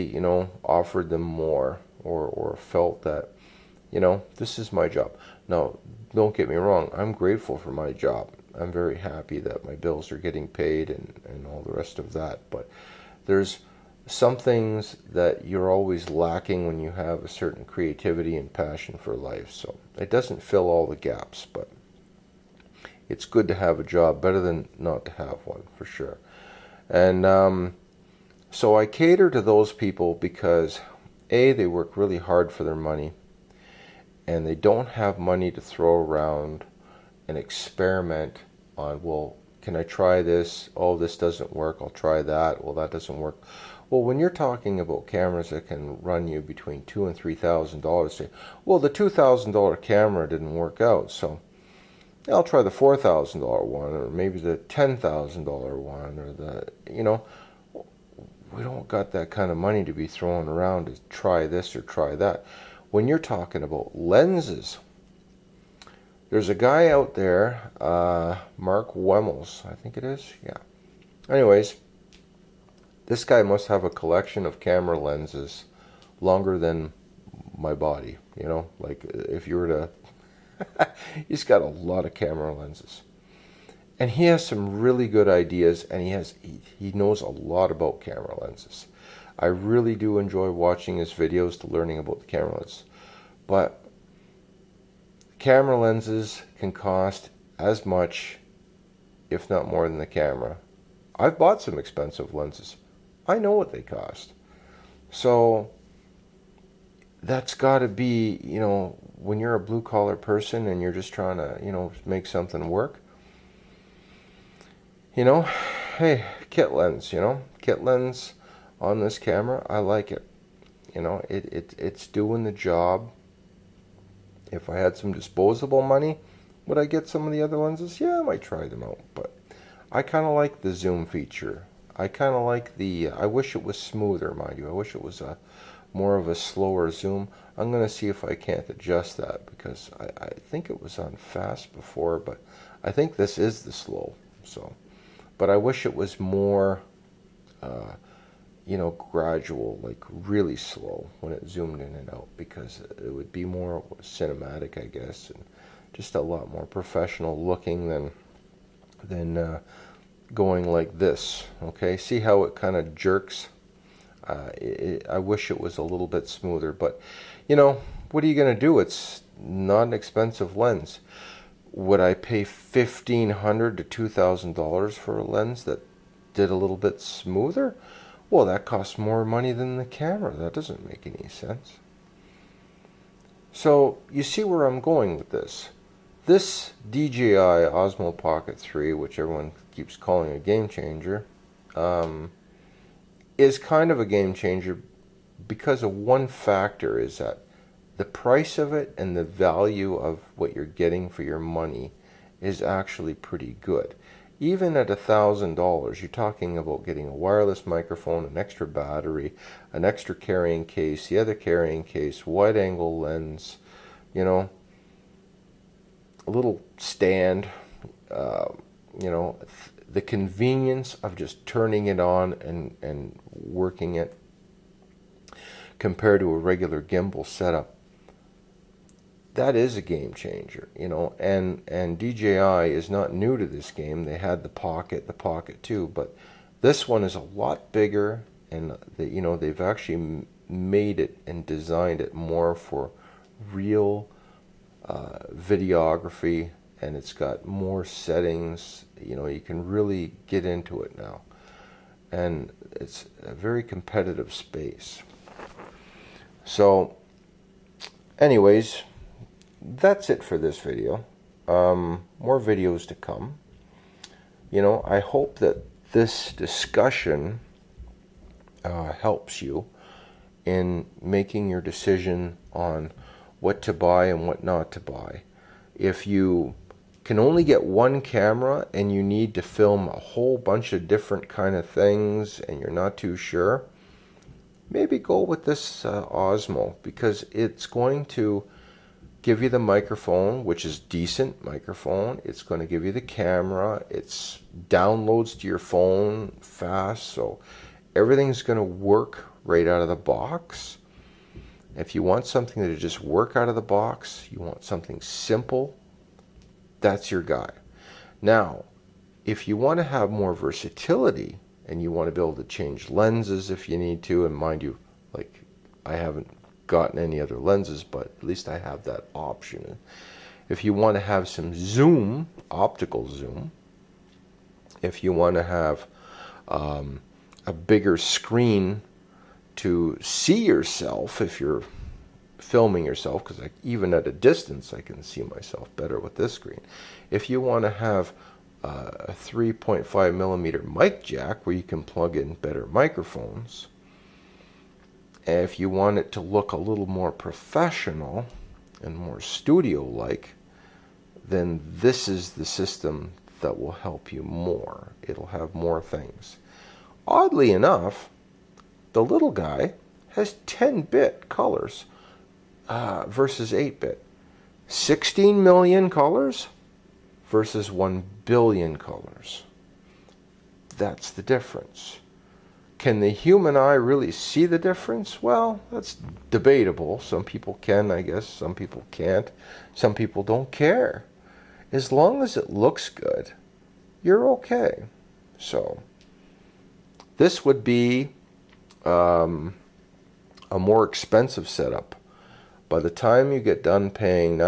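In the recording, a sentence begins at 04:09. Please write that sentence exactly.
You know, you can really get into it now.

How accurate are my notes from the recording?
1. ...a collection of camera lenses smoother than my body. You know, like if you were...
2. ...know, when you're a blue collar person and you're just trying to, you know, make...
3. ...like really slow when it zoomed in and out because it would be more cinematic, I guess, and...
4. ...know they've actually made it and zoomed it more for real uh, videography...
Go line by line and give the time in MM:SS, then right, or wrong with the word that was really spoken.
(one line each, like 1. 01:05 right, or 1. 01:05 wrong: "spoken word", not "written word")
1. 01:13 wrong: "longer", not "smoother"
2. 01:48 right
3. 02:29 right
4. 03:59 wrong: "designed", not "zoomed".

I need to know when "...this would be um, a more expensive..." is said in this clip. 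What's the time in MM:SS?
06:27.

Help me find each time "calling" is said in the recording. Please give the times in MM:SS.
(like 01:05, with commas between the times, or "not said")
03:09.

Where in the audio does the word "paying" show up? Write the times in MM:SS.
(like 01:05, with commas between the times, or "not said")
06:33.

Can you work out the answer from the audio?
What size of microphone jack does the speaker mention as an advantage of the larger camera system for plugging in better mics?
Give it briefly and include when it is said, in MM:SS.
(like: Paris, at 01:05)
3.5 millimeter, at 05:39.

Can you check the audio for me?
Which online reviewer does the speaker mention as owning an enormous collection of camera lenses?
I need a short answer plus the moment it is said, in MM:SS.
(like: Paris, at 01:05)
Mark Wemmels, at 01:08.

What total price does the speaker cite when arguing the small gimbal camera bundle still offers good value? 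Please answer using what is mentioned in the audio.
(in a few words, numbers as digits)
$1,000.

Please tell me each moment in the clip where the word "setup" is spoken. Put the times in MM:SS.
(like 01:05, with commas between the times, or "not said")
03:47, 06:31.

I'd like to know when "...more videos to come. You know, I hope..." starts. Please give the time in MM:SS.
04:22.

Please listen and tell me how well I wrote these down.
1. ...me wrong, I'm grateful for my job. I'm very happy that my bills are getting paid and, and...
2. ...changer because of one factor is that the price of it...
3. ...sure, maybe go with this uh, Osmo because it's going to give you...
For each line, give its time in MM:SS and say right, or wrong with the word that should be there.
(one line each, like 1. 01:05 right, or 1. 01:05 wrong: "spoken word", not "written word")
1. 00:06 right
2. 03:14 right
3. 04:43 right.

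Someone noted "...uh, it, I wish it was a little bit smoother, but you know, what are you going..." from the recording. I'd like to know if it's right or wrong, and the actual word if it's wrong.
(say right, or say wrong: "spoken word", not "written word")
right.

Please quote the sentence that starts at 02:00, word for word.
You know, it, it it's doing the job.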